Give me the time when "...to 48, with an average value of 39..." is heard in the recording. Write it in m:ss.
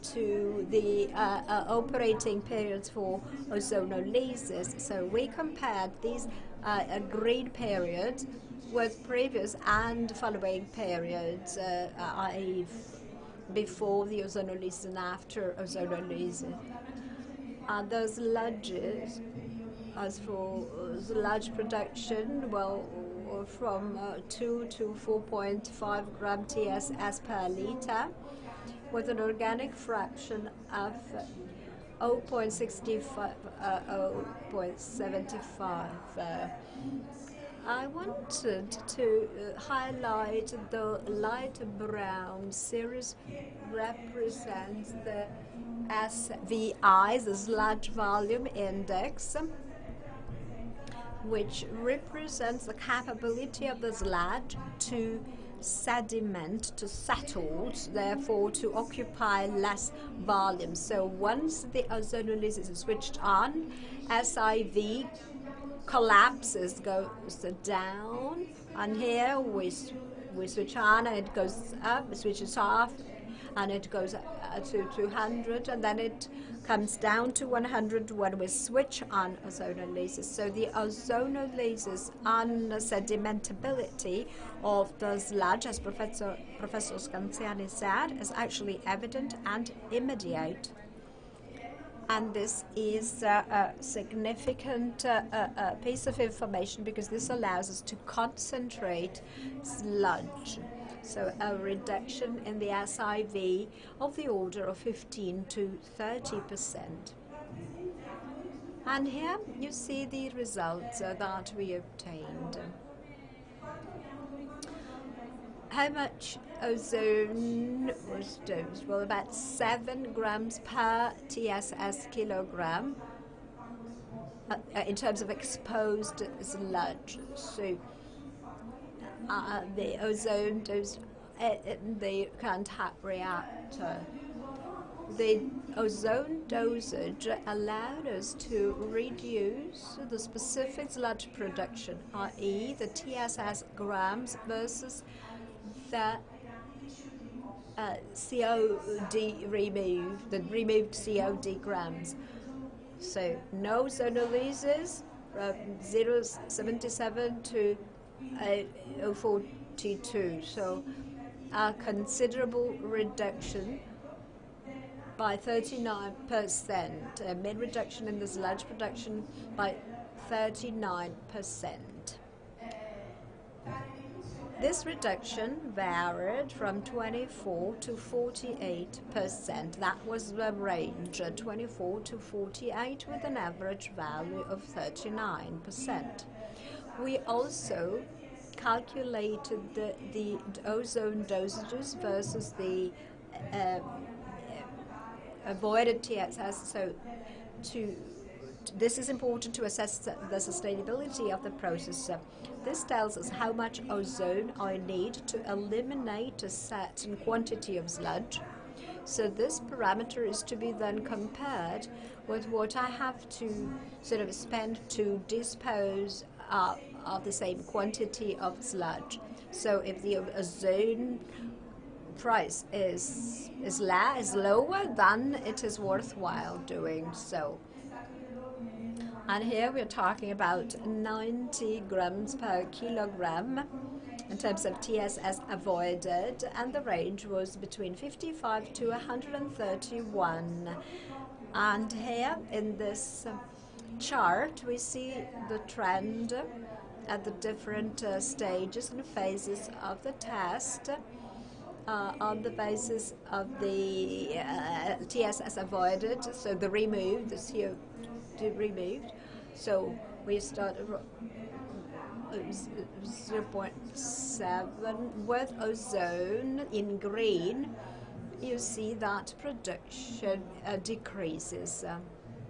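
3:02.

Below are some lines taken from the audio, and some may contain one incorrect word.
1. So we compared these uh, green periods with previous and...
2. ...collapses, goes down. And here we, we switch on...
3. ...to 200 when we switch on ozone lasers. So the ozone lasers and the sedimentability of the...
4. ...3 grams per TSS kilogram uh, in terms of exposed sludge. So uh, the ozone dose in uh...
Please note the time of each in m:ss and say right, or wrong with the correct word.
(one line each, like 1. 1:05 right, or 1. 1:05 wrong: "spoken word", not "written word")
1. 0:04 right
2. 1:05 right
3. 1:17 wrong: "100", not "200"
4. 1:59 wrong: "7", not "3".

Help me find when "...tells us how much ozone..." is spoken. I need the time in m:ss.
3:22.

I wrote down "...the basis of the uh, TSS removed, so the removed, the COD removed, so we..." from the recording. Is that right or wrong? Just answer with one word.
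wrong.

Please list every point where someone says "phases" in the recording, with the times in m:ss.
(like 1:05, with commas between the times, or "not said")
4:09.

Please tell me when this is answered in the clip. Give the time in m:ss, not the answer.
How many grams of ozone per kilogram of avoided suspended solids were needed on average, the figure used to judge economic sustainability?
3:50.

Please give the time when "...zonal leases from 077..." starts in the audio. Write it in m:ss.
2:33.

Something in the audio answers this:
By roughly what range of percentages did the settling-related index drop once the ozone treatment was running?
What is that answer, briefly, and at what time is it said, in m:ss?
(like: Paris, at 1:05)
15 to 30 percent, at 1:44.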